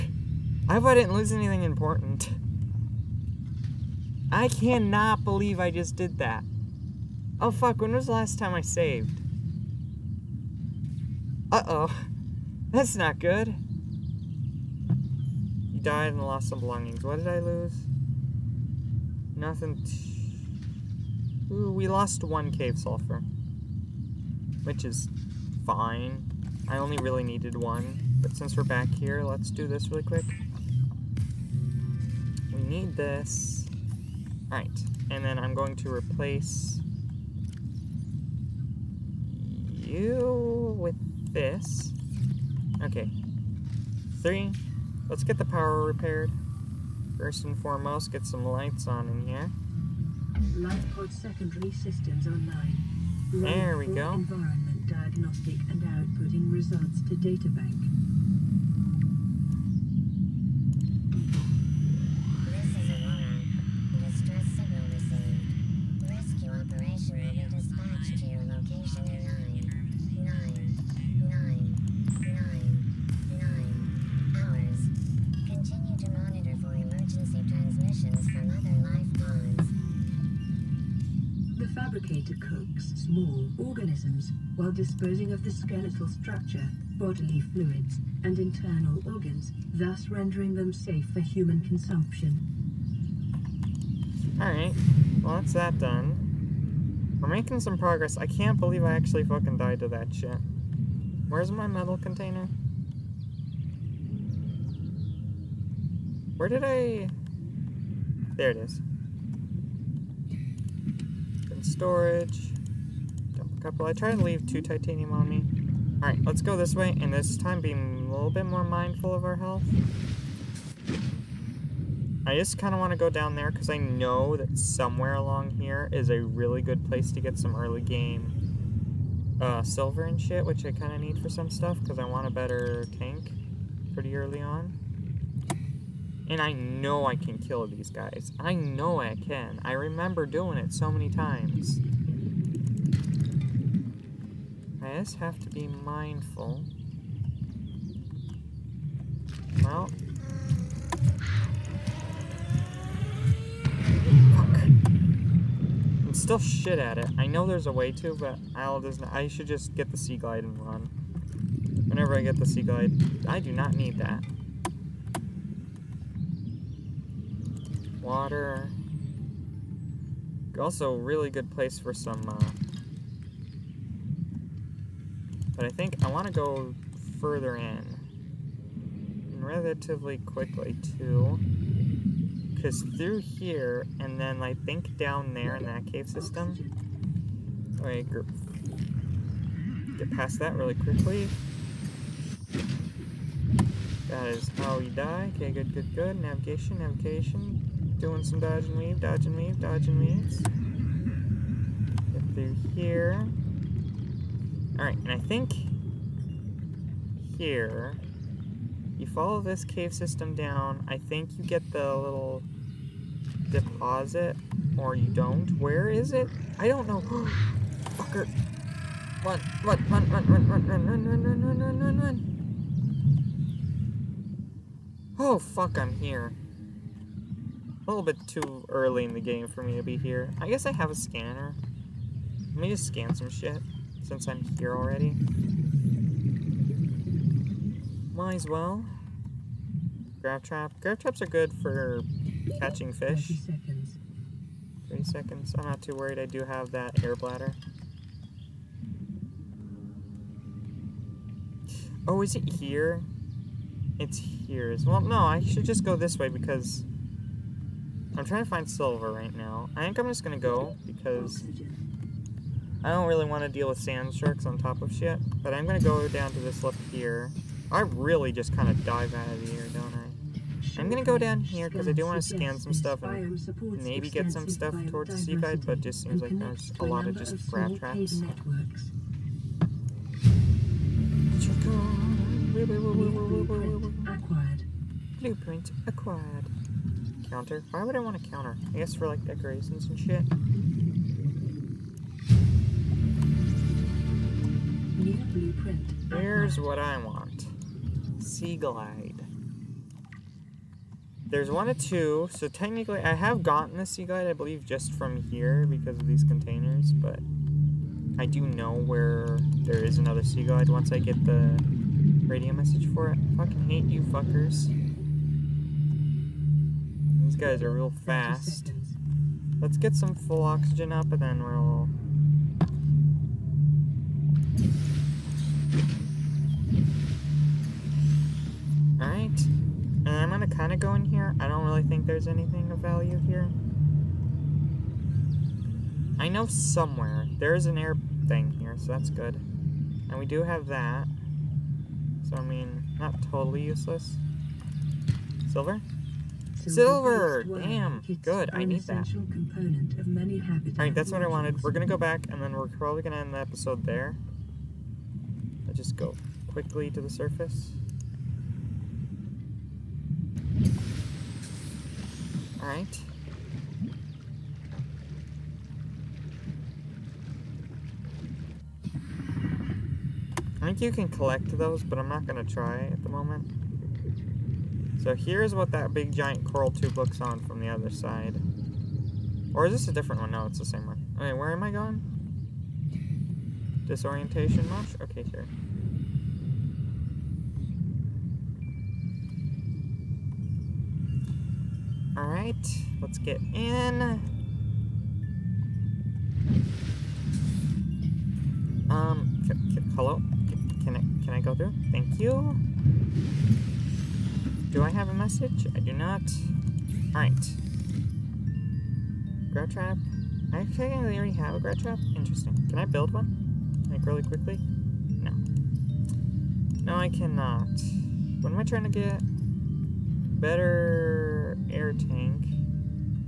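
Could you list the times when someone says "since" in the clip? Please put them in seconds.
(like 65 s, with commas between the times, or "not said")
28 s, 234 s.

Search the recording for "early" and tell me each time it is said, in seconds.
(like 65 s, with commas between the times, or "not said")
127 s, 134 s, 228 s.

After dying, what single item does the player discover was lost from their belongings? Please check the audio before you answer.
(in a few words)
Cave sulfur.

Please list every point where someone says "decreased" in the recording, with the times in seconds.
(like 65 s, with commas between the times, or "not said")
not said.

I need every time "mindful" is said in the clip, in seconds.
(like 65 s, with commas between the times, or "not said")
118 s, 145 s.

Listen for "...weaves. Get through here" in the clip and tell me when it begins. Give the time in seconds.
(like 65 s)
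199 s.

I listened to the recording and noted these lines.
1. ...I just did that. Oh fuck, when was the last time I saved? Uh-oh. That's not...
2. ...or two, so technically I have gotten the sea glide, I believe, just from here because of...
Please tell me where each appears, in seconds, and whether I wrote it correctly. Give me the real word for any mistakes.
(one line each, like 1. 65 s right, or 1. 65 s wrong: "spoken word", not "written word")
1. 5 s right
2. 301 s right.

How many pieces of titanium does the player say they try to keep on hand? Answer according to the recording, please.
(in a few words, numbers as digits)
2.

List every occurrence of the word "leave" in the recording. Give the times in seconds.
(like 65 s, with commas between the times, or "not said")
114 s.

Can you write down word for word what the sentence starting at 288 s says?
I guess for like decorations and shit.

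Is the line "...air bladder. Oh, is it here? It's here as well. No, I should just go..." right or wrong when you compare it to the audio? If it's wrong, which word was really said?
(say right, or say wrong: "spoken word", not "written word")
right.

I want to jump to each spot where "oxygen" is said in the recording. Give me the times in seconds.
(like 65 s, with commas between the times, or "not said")
320 s.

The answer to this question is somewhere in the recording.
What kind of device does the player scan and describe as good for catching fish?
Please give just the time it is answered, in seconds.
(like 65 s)
240 s.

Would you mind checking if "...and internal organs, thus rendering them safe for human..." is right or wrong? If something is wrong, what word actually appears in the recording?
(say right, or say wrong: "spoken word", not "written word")
right.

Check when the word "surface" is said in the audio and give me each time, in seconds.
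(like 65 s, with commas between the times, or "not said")
357 s.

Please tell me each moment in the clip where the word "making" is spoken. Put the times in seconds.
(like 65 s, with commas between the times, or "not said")
97 s.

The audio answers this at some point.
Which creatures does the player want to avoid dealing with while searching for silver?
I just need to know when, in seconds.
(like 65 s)
263 s.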